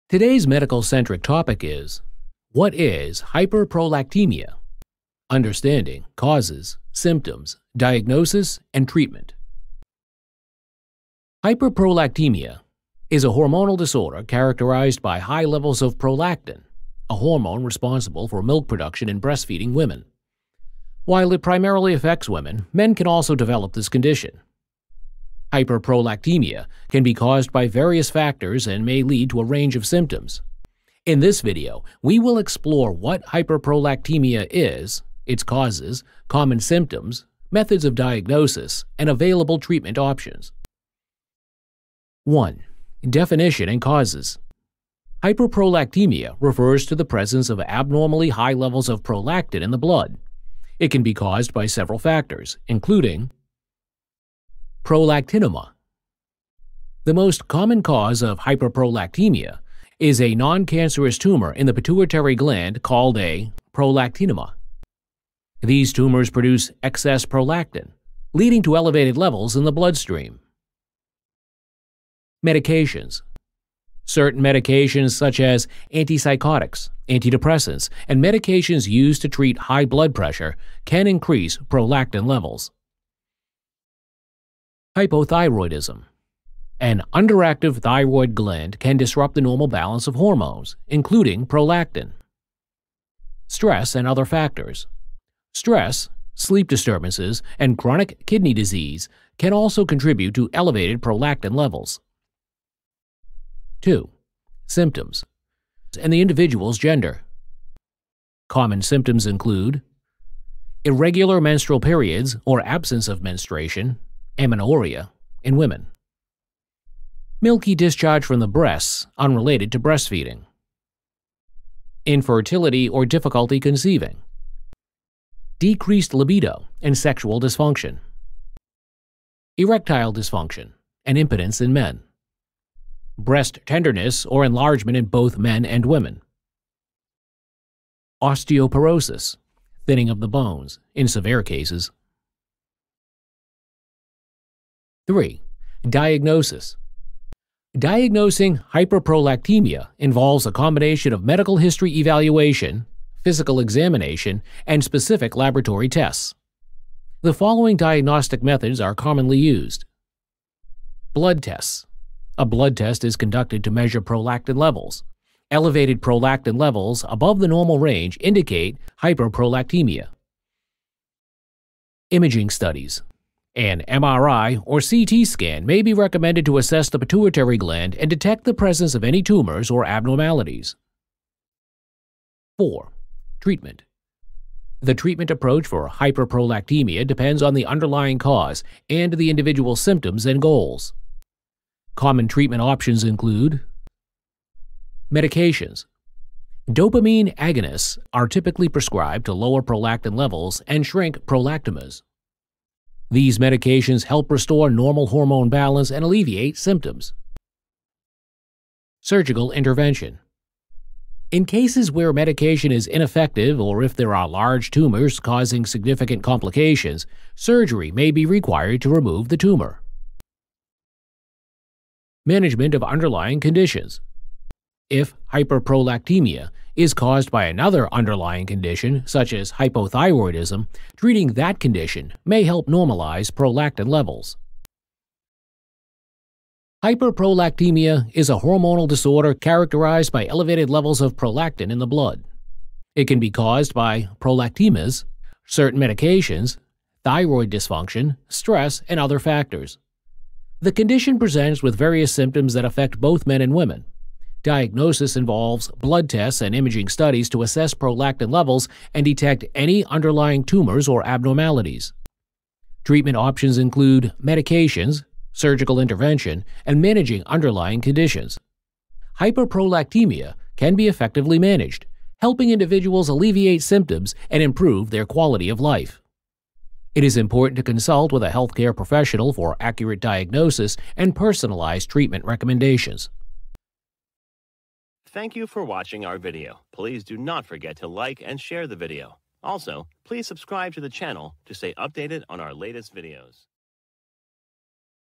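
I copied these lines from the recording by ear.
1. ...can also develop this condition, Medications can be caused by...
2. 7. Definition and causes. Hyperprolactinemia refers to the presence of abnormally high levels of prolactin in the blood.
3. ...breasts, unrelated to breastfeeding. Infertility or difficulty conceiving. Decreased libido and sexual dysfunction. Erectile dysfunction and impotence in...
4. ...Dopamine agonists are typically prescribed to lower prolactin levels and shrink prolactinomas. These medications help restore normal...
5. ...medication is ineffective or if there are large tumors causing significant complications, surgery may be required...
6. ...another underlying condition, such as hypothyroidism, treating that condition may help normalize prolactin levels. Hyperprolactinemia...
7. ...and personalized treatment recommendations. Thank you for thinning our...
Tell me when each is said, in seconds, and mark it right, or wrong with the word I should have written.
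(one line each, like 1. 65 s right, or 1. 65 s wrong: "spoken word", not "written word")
1. 22 s wrong: "Hyperprolactinemia", not "Medications"
2. 42 s wrong: "1", not "7"
3. 118 s right
4. 196 s right
5. 212 s right
6. 227 s right
7. 280 s wrong: "watching", not "thinning".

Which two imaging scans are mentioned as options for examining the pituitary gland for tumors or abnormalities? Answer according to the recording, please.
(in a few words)
MRI or CT scan.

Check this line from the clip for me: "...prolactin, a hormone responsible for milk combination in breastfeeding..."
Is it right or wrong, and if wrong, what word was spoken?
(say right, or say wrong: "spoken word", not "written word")
wrong: "production", not "combination".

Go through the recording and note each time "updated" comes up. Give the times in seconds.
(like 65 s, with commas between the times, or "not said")
291 s.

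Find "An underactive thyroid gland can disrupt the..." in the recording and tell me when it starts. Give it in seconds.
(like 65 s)
86 s.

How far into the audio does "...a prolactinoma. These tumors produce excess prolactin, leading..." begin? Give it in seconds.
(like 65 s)
63 s.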